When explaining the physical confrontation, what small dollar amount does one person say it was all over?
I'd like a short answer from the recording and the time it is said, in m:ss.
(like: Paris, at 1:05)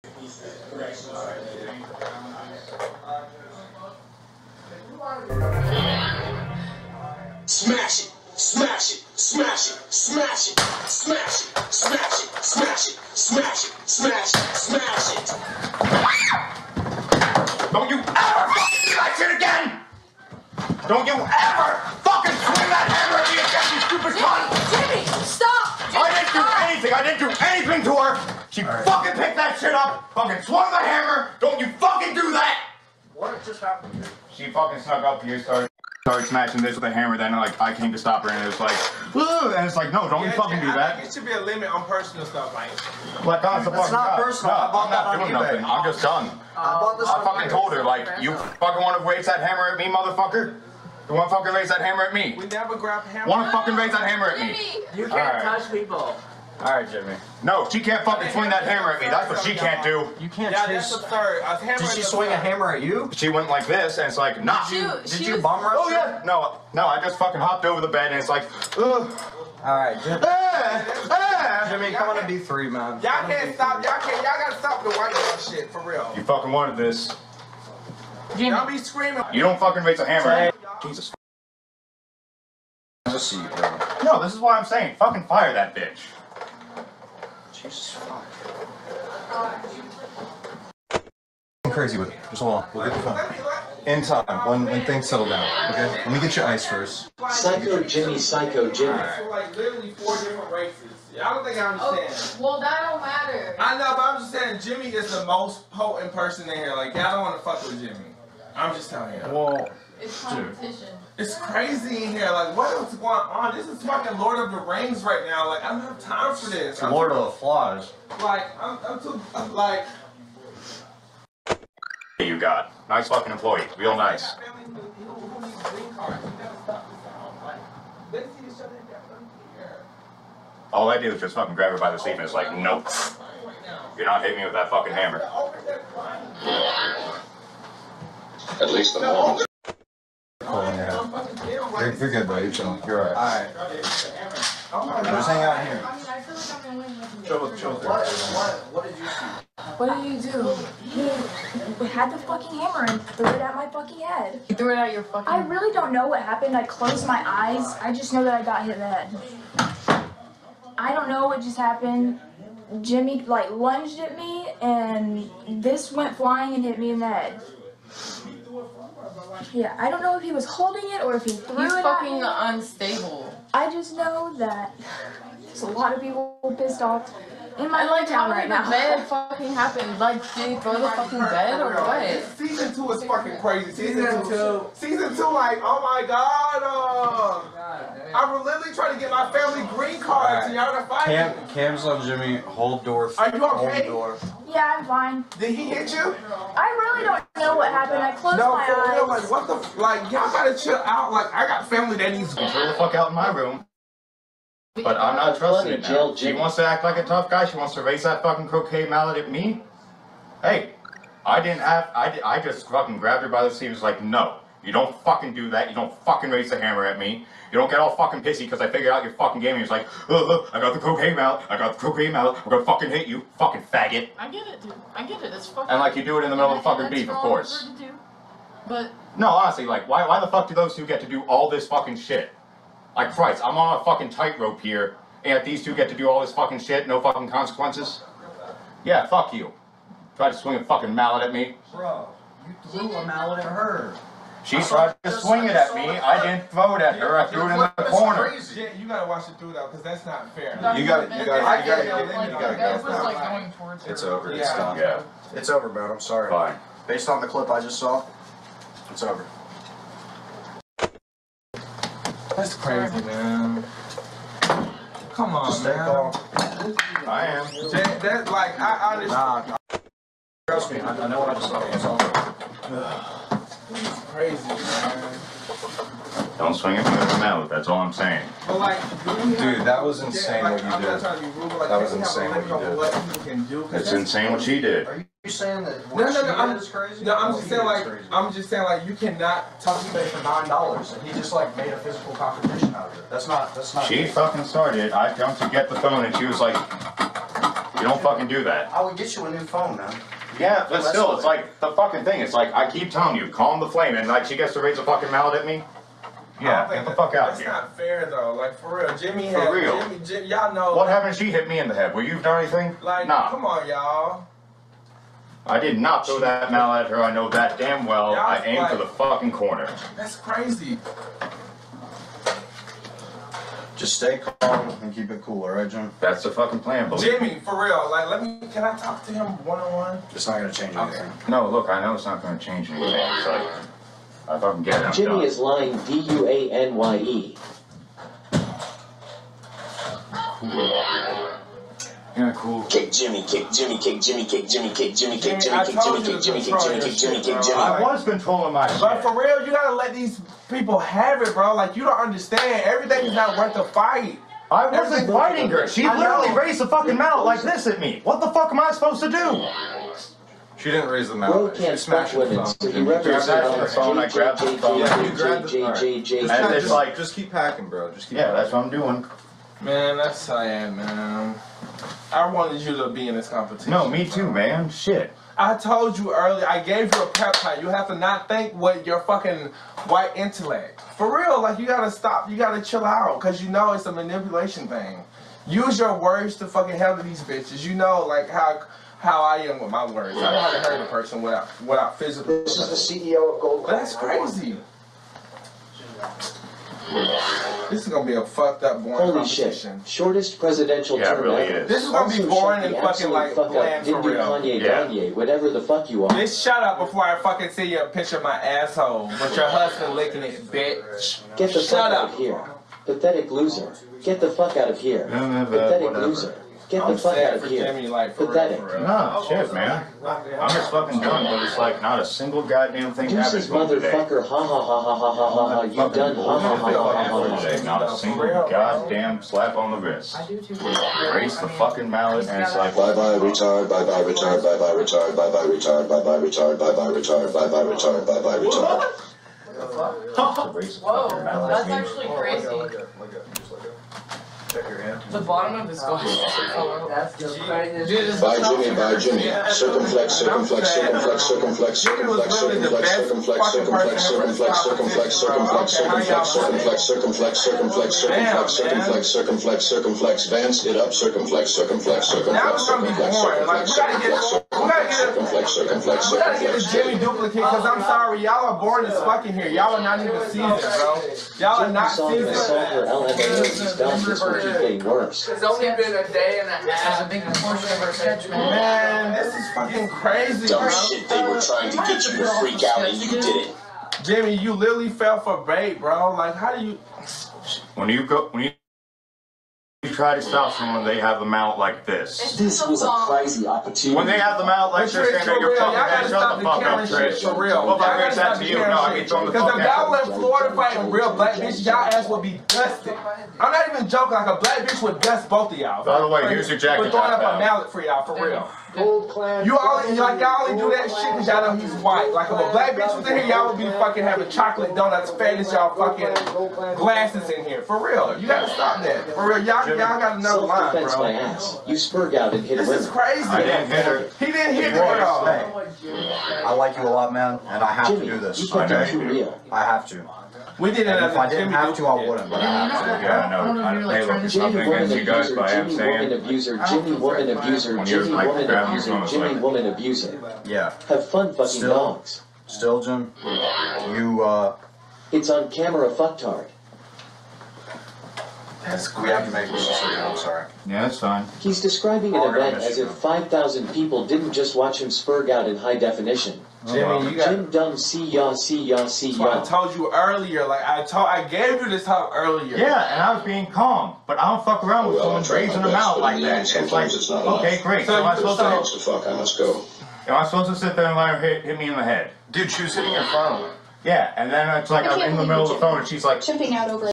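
9 dollars, at 4:50.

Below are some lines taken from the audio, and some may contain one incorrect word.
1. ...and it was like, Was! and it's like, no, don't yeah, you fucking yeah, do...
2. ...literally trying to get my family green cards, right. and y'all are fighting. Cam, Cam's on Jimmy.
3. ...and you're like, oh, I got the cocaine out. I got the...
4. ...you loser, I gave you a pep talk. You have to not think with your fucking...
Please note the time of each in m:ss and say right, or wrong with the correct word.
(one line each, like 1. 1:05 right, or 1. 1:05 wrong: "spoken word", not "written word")
1. 0:38 wrong: "Woo", not "Was"
2. 3:08 right
3. 3:39 right
4. 6:15 wrong: "earlier", not "loser".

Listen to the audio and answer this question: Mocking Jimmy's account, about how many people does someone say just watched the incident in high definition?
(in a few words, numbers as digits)
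5,000.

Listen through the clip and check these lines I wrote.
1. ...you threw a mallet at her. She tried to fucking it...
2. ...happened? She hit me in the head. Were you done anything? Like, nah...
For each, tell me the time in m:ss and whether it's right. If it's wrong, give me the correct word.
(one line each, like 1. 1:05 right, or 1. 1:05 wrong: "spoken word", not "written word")
1. 4:02 wrong: "swing", not "fucking"
2. 5:10 right.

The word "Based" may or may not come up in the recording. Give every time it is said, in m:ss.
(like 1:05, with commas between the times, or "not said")
4:16.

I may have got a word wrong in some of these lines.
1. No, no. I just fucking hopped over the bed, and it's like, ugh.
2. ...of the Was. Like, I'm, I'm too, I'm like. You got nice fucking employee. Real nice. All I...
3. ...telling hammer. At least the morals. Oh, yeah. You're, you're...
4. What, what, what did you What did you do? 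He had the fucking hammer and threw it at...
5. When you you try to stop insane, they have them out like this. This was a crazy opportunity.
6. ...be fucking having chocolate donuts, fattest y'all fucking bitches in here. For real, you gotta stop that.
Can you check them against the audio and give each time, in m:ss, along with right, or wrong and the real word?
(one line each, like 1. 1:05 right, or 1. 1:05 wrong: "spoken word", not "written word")
1. 1:06 right
2. 1:57 wrong: "Flies", not "Was"
3. 2:14 wrong: "fucking", not "telling"
4. 2:27 right
5. 8:08 wrong: "someone", not "insane"
6. 8:33 wrong: "glasses", not "bitches".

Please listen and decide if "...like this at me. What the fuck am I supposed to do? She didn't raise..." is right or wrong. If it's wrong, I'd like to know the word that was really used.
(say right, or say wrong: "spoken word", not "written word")
right.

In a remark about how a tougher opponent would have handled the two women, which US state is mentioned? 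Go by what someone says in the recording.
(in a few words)
Florida.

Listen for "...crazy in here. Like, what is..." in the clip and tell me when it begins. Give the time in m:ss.
1:51.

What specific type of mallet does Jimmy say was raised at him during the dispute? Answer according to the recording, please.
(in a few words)
croquet mallet.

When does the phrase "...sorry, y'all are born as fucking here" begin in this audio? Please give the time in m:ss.
7:47.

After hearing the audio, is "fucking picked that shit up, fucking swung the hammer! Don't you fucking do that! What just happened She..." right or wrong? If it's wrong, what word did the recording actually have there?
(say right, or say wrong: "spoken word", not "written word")
right.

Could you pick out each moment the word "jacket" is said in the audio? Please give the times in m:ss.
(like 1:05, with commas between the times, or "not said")
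8:26.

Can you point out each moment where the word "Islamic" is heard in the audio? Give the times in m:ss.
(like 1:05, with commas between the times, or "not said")
not said.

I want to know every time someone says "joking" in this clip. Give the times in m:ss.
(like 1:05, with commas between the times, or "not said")
8:23.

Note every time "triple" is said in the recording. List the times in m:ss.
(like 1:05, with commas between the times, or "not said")
not said.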